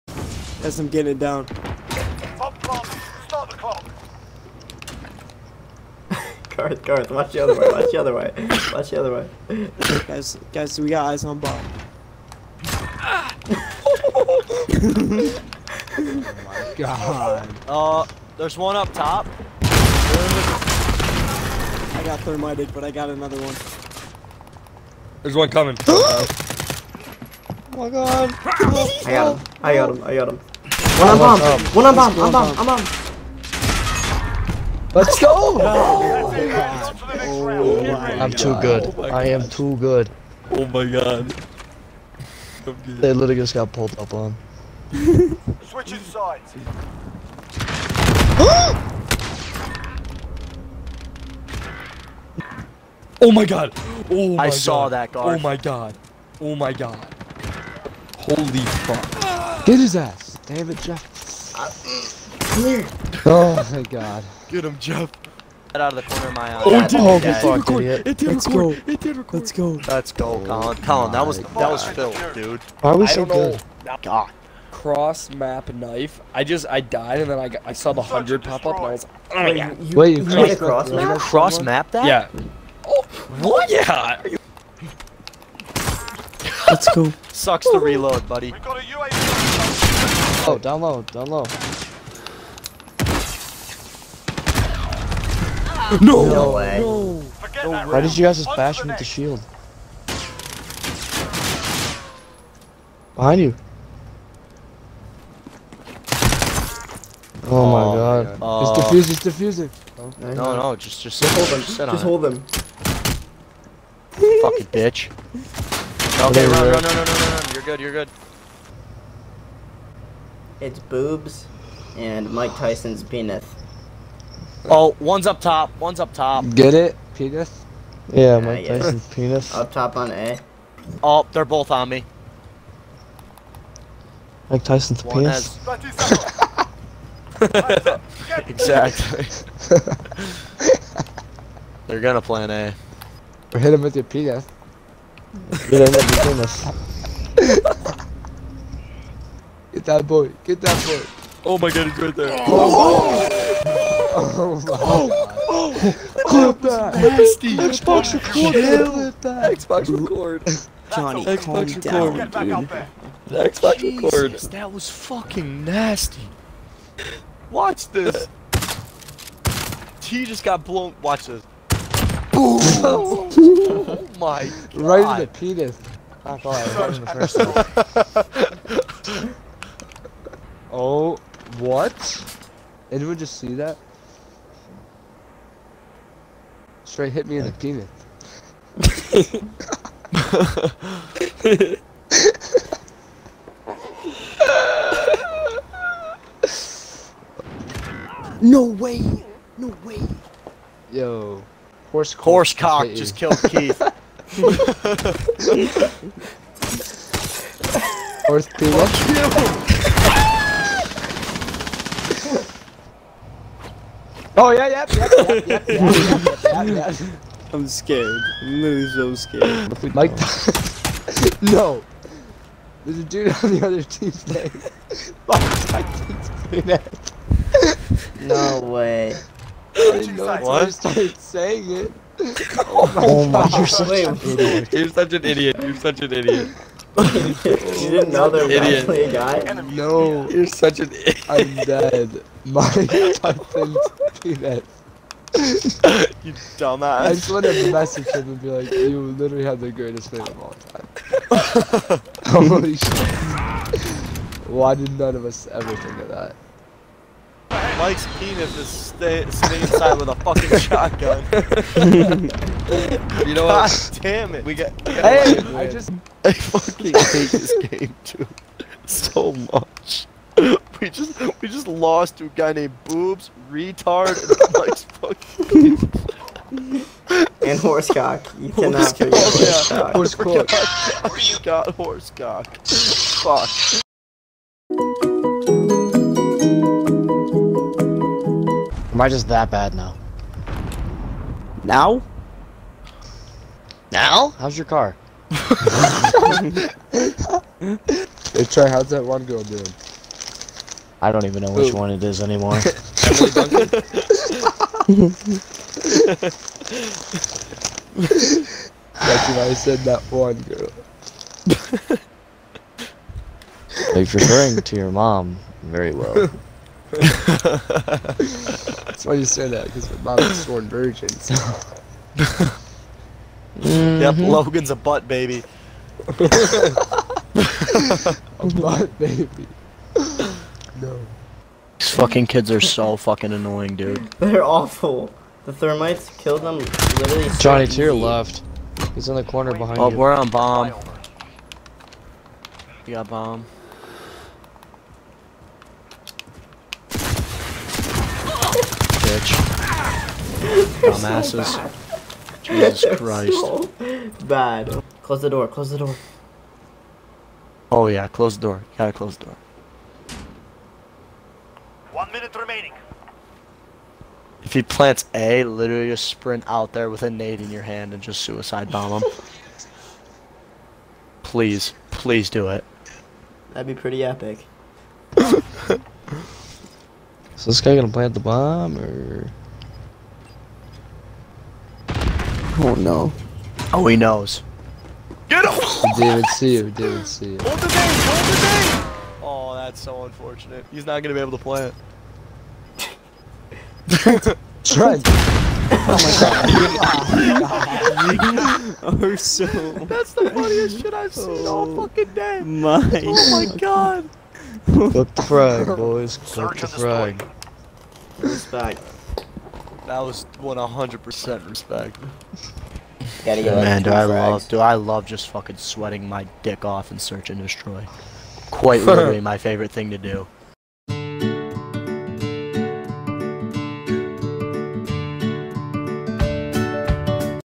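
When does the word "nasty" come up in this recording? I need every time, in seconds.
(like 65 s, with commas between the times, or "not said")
156 s, 165 s.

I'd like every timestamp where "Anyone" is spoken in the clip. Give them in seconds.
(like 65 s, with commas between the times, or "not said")
182 s.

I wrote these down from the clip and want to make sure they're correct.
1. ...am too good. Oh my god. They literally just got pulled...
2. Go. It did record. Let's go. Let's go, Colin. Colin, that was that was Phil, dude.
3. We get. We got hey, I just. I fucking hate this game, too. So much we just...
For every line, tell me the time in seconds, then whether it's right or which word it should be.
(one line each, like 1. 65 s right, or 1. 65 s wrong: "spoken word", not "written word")
1. 39 s right
2. 68 s right
3. 264 s right.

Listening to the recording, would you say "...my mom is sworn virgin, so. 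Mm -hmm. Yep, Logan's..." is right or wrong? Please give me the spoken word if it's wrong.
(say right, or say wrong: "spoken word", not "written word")
right.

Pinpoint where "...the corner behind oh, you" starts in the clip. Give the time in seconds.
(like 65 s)
339 s.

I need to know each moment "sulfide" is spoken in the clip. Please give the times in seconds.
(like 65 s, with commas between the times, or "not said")
not said.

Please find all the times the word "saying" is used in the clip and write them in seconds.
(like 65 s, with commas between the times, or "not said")
231 s.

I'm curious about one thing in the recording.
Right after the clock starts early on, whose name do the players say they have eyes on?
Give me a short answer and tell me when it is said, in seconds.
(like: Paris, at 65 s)
Bob, at 11 s.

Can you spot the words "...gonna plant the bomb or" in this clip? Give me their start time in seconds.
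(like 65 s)
377 s.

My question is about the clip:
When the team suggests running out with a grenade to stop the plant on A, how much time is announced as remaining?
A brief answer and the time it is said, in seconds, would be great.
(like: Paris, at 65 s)
One minute, at 361 s.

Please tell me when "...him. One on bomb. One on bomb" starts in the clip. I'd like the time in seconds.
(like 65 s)
30 s.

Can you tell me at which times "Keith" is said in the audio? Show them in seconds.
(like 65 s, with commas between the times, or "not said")
203 s.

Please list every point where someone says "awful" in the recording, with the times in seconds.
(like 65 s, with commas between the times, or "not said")
334 s.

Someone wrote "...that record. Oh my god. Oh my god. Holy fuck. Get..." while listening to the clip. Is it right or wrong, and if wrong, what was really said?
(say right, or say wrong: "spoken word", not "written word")
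wrong: "guard", not "record".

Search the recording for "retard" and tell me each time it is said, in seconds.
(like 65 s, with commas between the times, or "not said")
273 s.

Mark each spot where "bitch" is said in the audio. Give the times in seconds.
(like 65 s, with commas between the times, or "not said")
114 s, 346 s.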